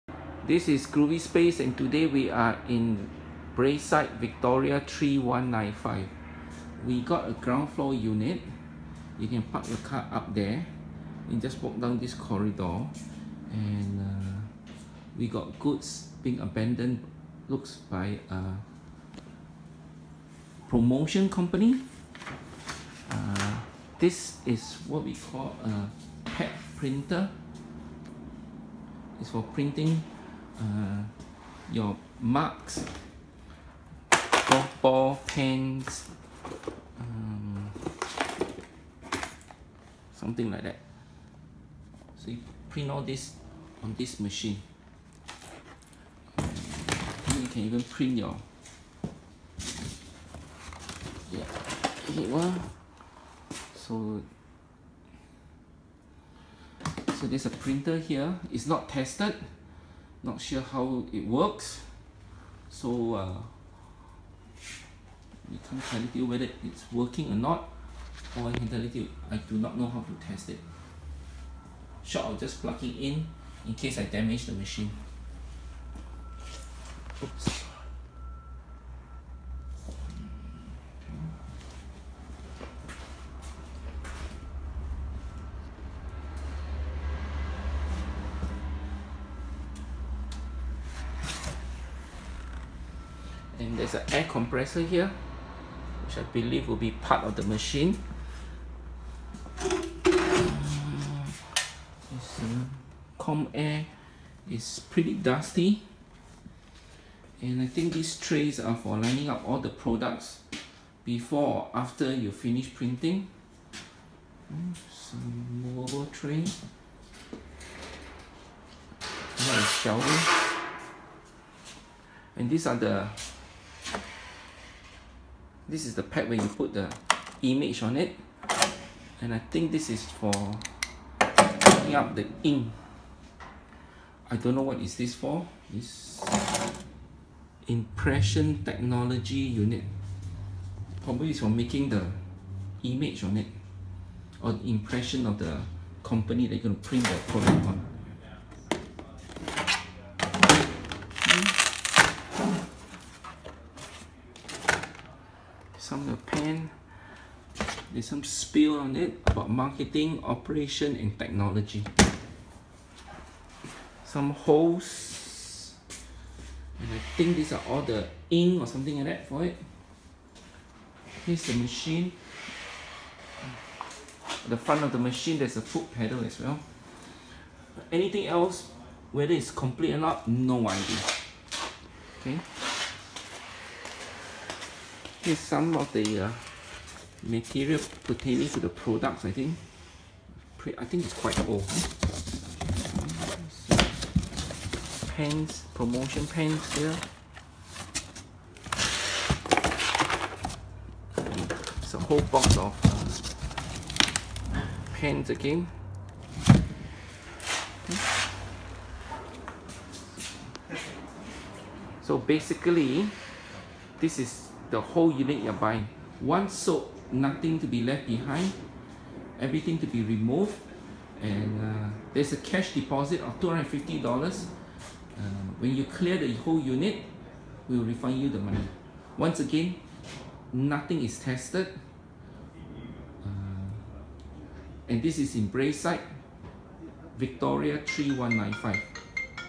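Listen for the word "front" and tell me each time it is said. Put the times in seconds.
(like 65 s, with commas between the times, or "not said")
174 s.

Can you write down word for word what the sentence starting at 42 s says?
So you print all this on this machine.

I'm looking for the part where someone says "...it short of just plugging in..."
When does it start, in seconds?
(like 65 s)
70 s.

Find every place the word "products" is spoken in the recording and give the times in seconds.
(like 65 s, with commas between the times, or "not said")
109 s, 147 s, 188 s.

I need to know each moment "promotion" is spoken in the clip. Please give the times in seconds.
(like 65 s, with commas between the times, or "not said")
20 s, 195 s.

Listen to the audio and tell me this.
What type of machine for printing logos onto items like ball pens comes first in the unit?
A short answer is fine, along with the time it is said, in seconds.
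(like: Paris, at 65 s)
Pad printer, at 26 s.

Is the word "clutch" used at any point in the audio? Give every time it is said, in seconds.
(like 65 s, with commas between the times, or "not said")
not said.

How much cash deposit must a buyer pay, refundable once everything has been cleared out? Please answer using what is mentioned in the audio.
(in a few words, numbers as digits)
$250.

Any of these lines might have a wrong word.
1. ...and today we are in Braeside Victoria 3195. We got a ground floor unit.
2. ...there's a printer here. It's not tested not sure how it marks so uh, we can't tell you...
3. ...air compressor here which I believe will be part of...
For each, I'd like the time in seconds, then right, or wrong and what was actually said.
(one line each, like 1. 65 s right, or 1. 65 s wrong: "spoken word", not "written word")
1. 1 s right
2. 57 s wrong: "works", not "marks"
3. 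94 s right.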